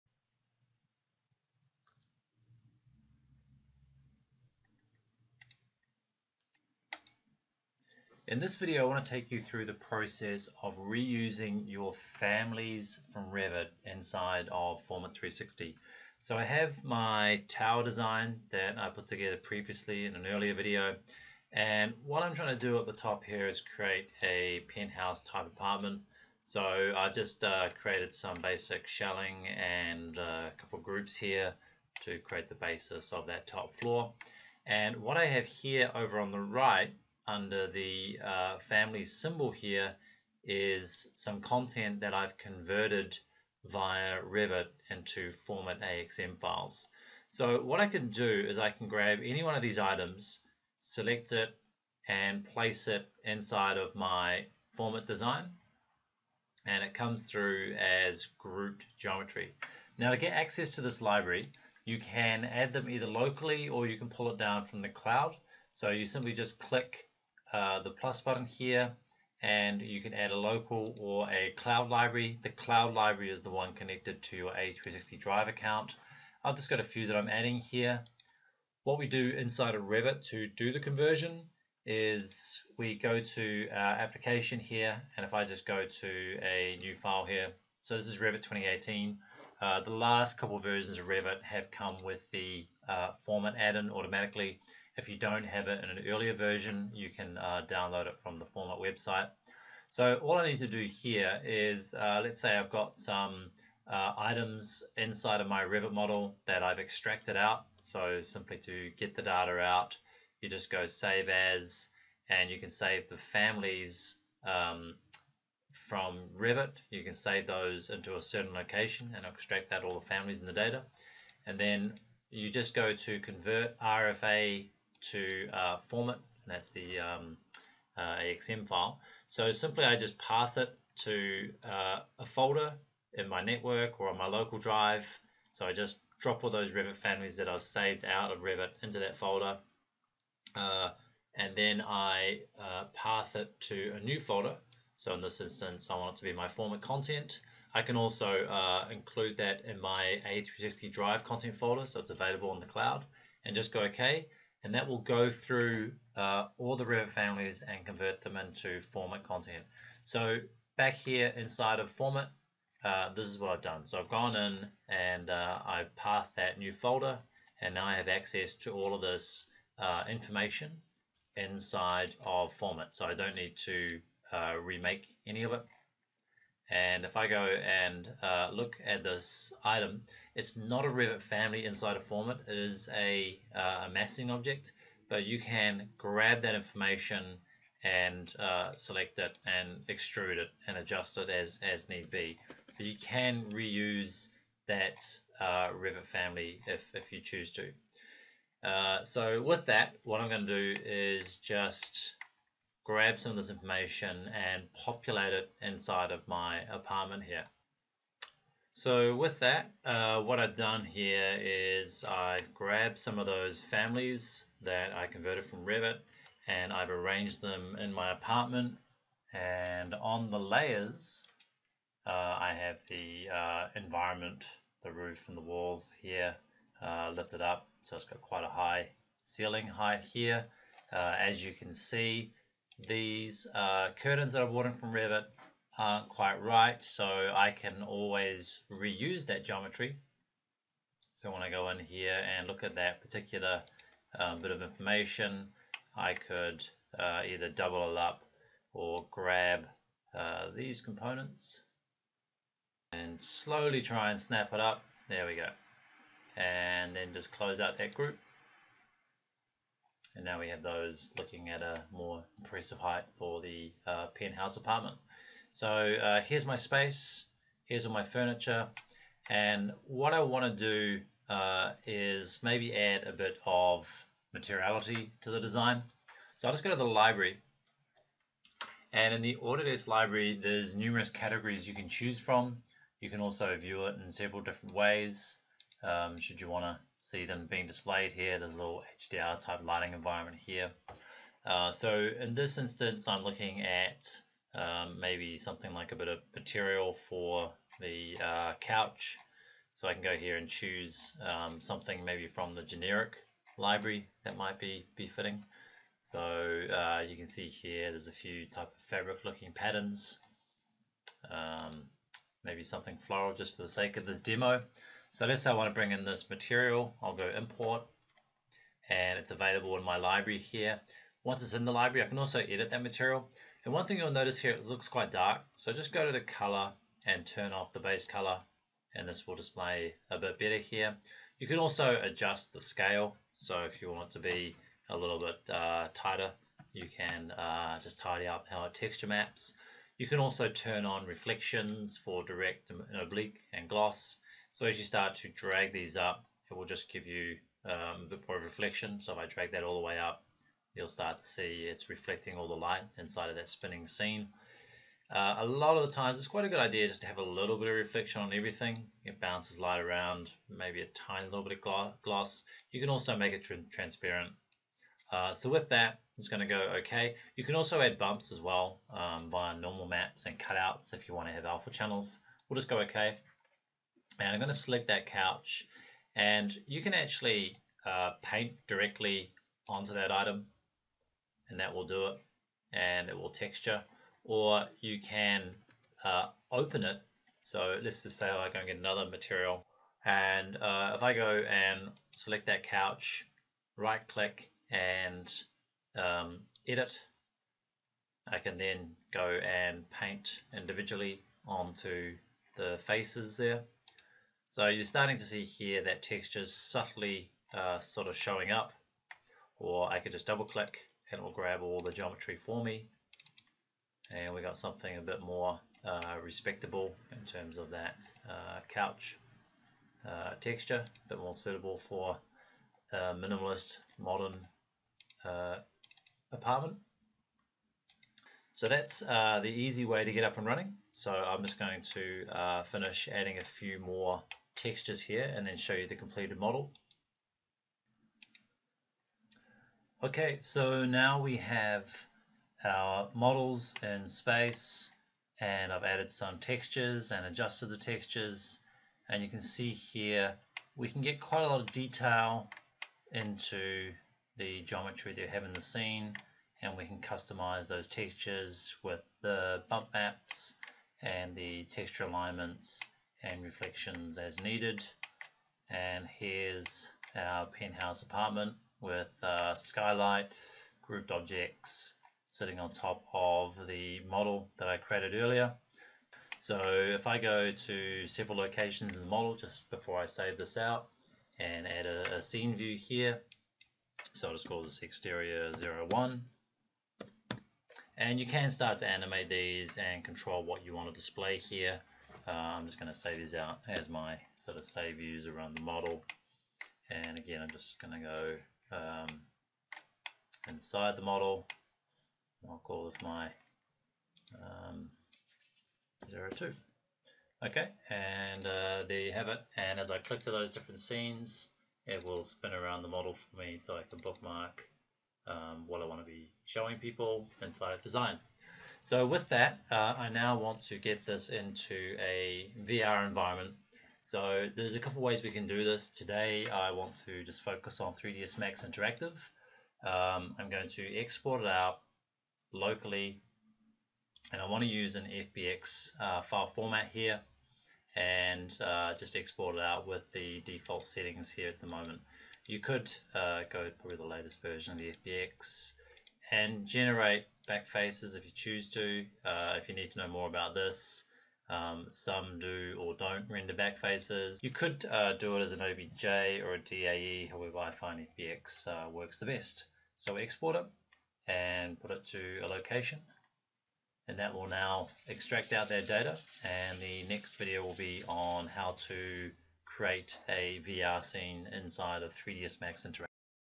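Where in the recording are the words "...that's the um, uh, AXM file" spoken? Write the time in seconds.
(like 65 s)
126 s.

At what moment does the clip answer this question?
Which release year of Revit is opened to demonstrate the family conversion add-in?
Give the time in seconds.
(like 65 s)
88 s.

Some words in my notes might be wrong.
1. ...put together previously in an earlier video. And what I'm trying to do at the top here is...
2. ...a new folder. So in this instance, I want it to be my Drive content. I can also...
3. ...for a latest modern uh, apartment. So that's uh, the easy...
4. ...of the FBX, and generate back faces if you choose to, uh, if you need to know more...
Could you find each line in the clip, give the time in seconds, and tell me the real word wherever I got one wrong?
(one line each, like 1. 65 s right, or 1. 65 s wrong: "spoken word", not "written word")
1. 18 s right
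2. 143 s wrong: "FormIt", not "Drive"
3. 421 s wrong: "minimalist", not "latest"
4. 544 s right.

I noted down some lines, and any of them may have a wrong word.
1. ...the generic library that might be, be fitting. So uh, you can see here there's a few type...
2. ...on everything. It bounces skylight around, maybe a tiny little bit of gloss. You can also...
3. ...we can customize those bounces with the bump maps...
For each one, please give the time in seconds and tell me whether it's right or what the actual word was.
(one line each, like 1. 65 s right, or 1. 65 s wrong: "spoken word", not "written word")
1. 302 s right
2. 358 s wrong: "light", not "skylight"
3. 456 s wrong: "textures", not "bounces".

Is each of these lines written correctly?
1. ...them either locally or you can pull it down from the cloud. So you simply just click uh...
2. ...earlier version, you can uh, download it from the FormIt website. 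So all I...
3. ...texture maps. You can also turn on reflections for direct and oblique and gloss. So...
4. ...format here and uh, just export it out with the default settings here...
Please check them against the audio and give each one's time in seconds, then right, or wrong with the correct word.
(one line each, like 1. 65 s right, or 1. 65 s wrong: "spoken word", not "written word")
1. 62 s right
2. 96 s right
3. 338 s right
4. 536 s right.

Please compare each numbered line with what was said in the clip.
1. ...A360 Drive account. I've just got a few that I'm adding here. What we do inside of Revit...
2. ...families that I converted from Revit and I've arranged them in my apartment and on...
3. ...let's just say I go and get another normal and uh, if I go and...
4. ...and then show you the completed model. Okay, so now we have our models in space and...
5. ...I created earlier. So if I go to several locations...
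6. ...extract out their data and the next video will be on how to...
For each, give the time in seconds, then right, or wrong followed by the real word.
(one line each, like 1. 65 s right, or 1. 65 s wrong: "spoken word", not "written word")
1. 74 s right
2. 213 s right
3. 387 s wrong: "material", not "normal"
4. 435 s right
5. 474 s right
6. 565 s right.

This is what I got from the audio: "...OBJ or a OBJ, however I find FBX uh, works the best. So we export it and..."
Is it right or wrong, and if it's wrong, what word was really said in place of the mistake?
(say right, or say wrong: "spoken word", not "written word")
wrong: "DAE", not "OBJ".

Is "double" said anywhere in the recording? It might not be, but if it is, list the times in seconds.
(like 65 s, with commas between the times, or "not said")
247 s, 410 s.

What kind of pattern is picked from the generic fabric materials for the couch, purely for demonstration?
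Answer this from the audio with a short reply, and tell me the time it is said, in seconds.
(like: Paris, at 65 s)
floral, at 312 s.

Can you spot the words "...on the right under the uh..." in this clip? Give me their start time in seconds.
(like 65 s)
36 s.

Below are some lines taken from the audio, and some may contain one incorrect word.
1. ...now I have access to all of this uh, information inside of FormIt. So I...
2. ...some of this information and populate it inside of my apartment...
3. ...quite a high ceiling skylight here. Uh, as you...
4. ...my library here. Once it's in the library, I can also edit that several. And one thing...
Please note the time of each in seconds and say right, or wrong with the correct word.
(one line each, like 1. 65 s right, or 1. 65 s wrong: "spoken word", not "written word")
1. 167 s right
2. 203 s right
3. 228 s wrong: "height", not "skylight"
4. 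319 s wrong: "material", not "several".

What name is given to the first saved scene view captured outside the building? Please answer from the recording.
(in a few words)
exterior 01.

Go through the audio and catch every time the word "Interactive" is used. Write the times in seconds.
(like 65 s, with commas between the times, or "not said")
528 s, 572 s.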